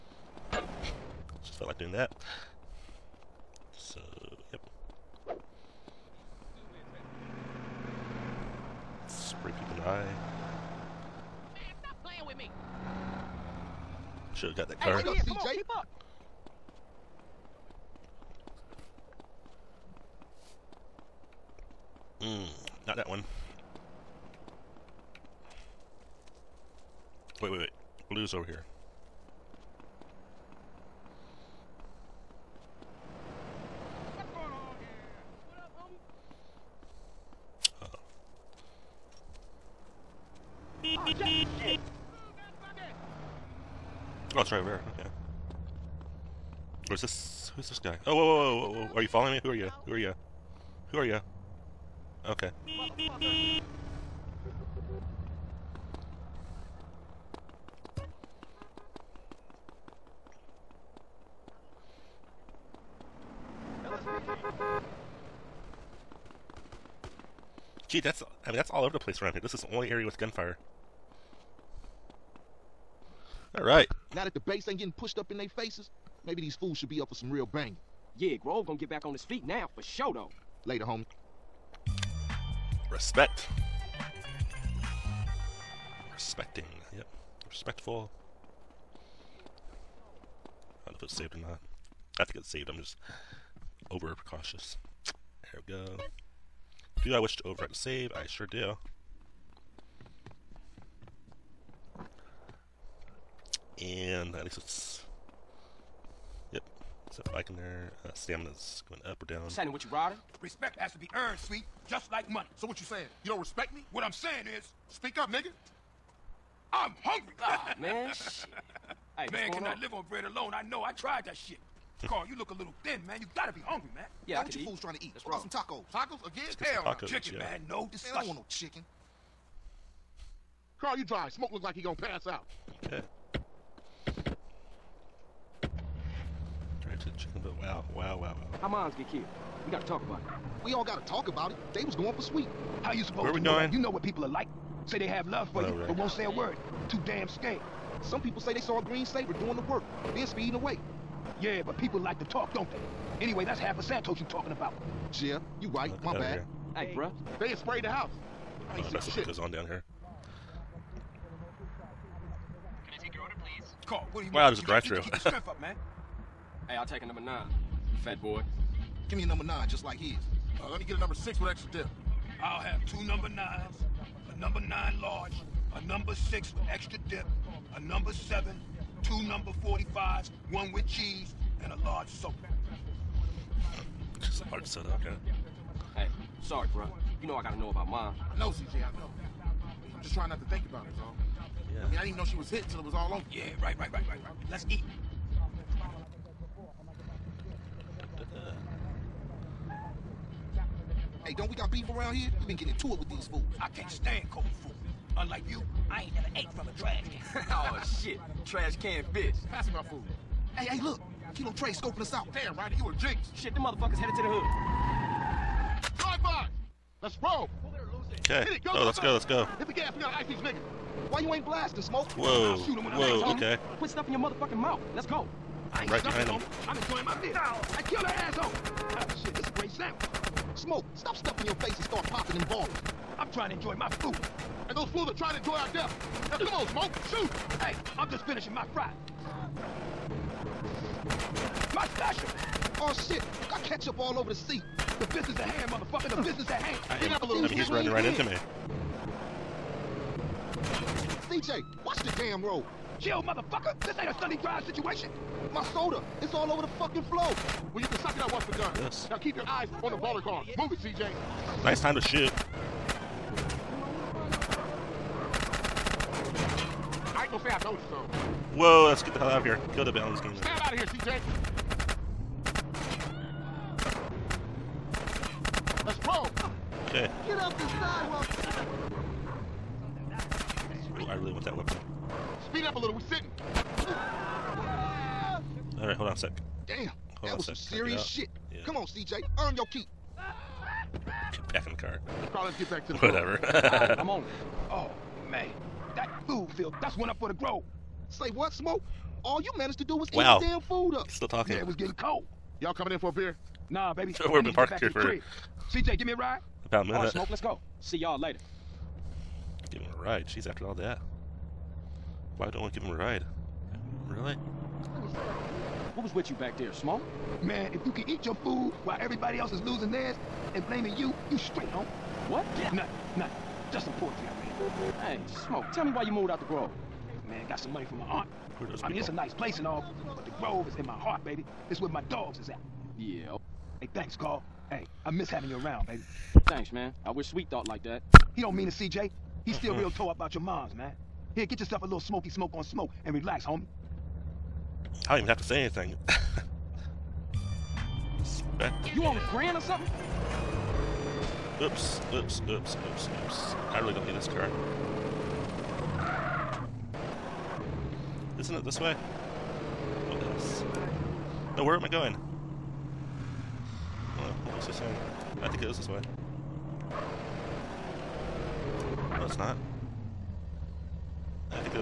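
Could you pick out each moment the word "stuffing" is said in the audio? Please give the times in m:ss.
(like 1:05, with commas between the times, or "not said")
3:43, 3:51.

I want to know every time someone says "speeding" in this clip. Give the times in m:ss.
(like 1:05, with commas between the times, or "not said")
2:30.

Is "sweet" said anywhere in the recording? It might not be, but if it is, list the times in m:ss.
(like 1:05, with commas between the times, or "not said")
1:51, 2:22, 5:37.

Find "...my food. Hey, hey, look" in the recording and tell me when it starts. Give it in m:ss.
3:29.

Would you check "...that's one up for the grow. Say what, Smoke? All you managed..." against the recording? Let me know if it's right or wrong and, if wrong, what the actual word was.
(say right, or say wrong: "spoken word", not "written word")
right.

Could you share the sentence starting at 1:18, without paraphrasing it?
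Yeah, Grove gonna get back on his feet now, for sure though.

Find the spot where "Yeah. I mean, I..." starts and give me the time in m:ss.
3:11.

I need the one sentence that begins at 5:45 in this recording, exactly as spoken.
I don't even have to say anything.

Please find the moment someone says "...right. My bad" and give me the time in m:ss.
2:35.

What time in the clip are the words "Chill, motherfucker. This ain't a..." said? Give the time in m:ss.
4:12.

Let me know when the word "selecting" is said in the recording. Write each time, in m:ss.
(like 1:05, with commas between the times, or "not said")
not said.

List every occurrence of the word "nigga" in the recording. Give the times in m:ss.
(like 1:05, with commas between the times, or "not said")
1:55, 3:40.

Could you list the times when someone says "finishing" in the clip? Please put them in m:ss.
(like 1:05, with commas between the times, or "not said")
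3:58.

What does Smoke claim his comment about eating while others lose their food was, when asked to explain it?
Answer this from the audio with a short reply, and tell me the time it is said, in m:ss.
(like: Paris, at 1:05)
poetry, at 5:23.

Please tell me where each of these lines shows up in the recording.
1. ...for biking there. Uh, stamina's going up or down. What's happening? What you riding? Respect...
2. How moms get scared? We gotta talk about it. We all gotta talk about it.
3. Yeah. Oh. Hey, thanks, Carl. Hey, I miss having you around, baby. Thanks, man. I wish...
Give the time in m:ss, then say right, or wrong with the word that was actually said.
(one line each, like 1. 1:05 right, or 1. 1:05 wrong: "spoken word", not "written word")
1. 1:47 right
2. 2:18 wrong: "killed", not "scared"
3. 5:32 right.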